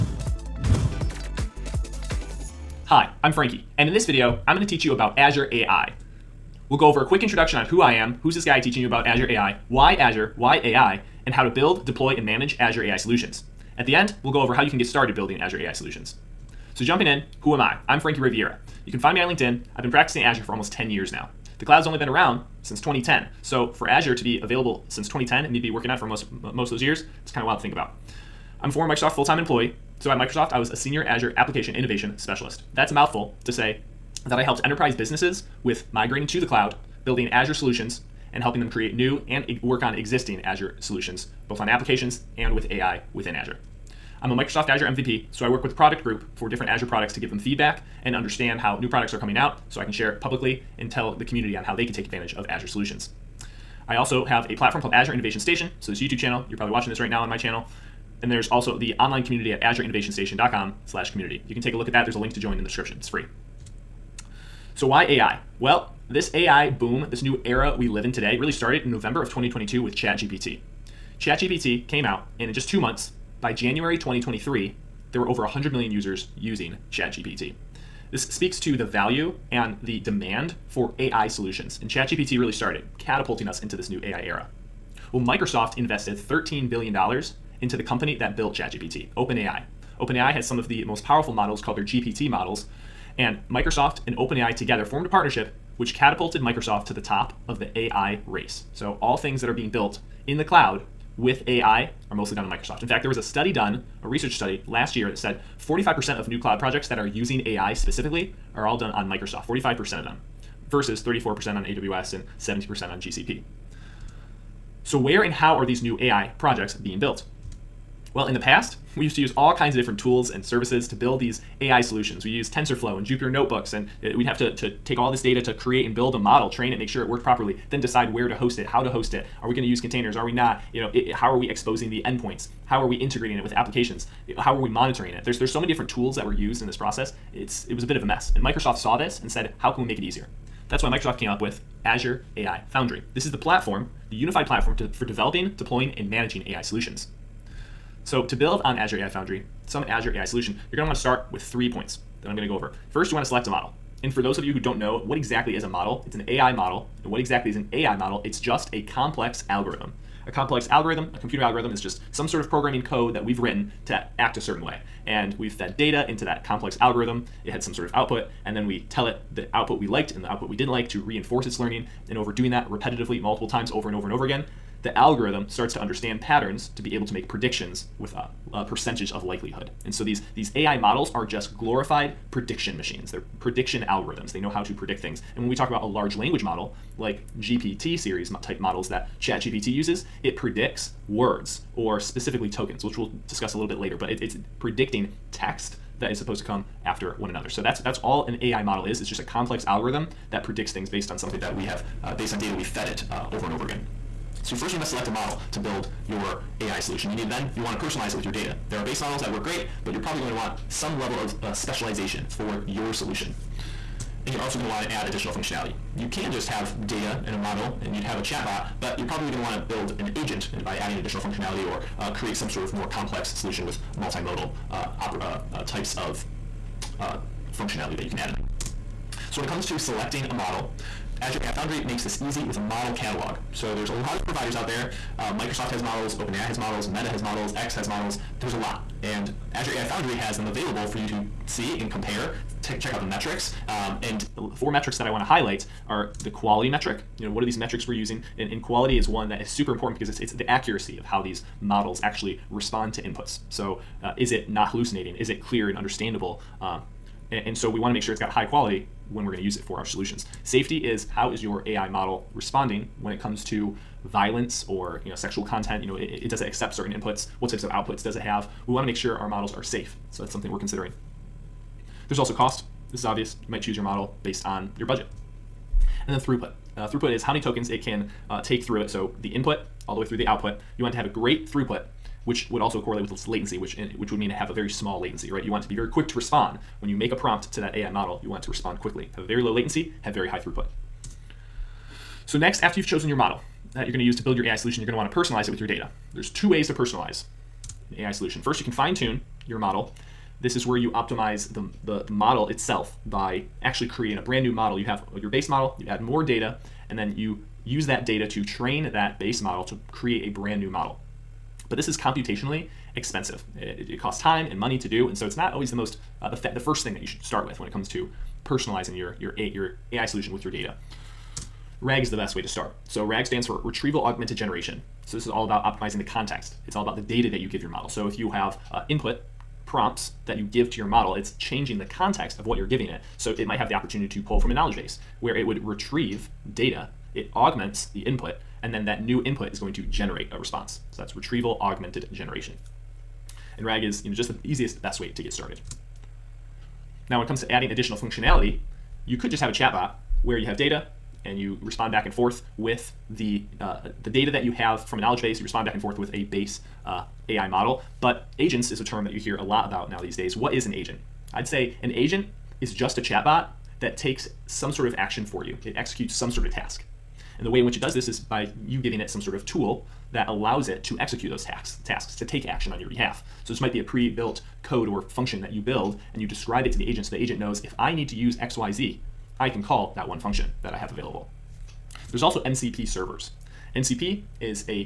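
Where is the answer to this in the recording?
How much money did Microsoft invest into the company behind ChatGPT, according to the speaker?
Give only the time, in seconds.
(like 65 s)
86 s.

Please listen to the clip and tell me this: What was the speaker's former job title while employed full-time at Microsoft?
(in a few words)
Senior Azure application innovation specialist.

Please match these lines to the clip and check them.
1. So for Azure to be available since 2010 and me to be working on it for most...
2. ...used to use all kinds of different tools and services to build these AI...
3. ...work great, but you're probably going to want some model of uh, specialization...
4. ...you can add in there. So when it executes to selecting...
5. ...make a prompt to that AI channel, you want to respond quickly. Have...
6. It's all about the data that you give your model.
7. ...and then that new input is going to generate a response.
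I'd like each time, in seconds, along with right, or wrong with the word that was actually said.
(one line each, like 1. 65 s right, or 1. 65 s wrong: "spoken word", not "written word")
1. 23 s right
2. 119 s right
3. 209 s wrong: "level", not "model"
4. 228 s wrong: "comes", not "executes"
5. 286 s wrong: "model", not "channel"
6. 326 s right
7. 338 s right.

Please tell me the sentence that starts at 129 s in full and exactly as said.
Are we going to use containers?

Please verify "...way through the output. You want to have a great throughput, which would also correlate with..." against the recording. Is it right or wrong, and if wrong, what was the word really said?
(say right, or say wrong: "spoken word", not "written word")
right.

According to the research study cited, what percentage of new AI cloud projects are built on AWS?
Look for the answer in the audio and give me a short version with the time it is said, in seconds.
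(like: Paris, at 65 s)
34%, at 111 s.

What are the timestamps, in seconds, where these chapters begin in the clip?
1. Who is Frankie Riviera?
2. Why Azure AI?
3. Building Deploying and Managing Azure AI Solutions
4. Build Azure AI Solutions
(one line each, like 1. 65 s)
1. 15 s
2. 63 s
3. 113 s
4. 147 s.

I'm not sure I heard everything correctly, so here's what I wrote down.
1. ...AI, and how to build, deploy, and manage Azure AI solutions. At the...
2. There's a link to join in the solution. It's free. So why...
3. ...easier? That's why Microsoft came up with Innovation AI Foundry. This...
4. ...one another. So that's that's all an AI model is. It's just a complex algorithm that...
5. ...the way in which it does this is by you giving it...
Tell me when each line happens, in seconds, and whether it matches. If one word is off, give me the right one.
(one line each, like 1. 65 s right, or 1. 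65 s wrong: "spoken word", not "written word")
1. 10 s right
2. 62 s wrong: "description", not "solution"
3. 140 s wrong: "Azure", not "Innovation"
4. 197 s right
5. 367 s right.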